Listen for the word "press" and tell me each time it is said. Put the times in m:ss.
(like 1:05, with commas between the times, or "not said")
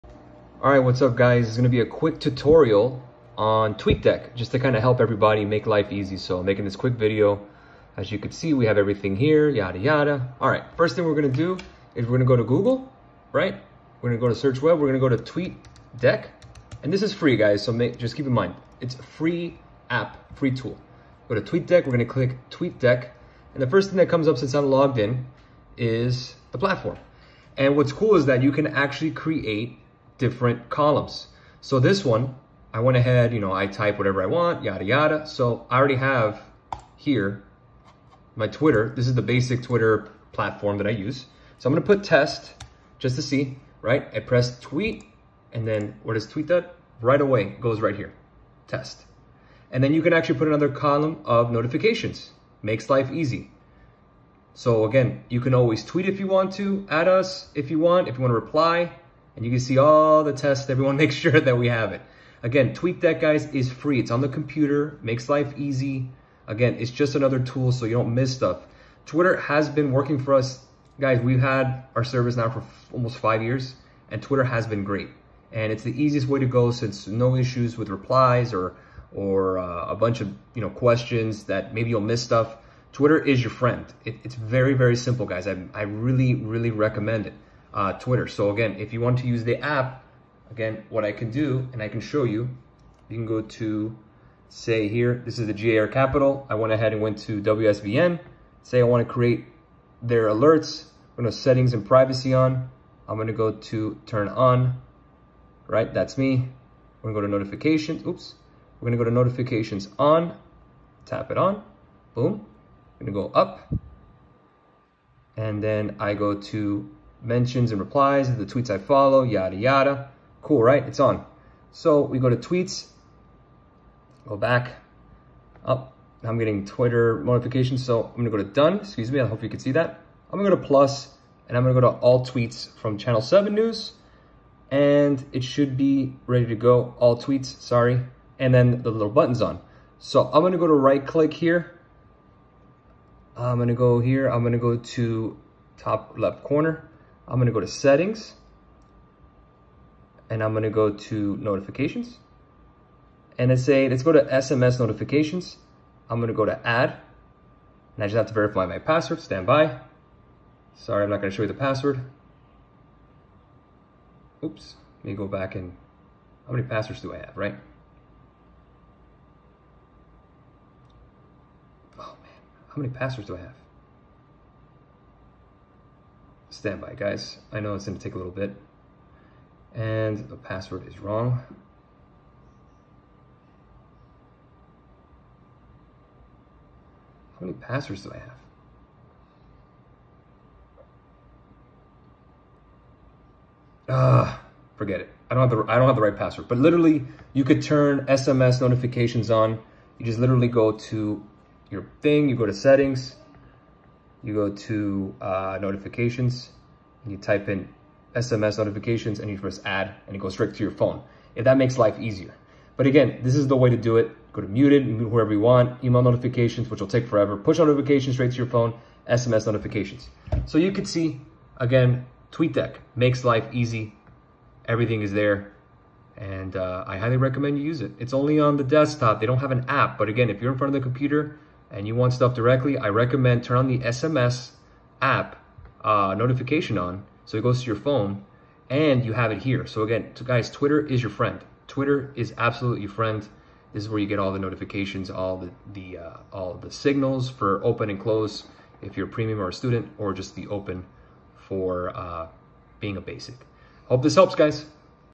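0:44, 3:29.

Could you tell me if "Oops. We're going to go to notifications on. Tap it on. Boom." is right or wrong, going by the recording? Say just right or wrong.
right.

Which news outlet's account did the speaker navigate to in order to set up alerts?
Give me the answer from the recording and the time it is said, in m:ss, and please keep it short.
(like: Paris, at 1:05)
WSVN, at 1:37.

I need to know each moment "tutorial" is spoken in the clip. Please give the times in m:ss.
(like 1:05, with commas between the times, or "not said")
0:02.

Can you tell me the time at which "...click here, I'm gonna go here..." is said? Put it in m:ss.
2:21.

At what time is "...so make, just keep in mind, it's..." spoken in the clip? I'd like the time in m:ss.
0:17.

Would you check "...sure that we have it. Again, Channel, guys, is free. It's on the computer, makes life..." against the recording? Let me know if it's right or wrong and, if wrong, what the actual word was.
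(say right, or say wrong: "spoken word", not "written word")
wrong: "TweetDeck", not "Channel".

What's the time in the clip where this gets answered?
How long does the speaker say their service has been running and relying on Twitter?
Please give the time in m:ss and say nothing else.
1:12.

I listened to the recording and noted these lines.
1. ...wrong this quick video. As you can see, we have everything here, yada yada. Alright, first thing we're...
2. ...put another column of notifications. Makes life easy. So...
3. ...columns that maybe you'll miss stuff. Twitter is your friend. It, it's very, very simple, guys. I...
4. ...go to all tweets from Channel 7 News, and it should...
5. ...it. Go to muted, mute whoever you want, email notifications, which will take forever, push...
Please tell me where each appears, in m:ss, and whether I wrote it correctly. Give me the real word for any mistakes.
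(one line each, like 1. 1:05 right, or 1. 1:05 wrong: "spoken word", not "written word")
1. 0:06 wrong: "making", not "wrong"
2. 0:50 right
3. 1:20 wrong: "questions", not "columns"
4. 2:11 right
5. 3:33 right.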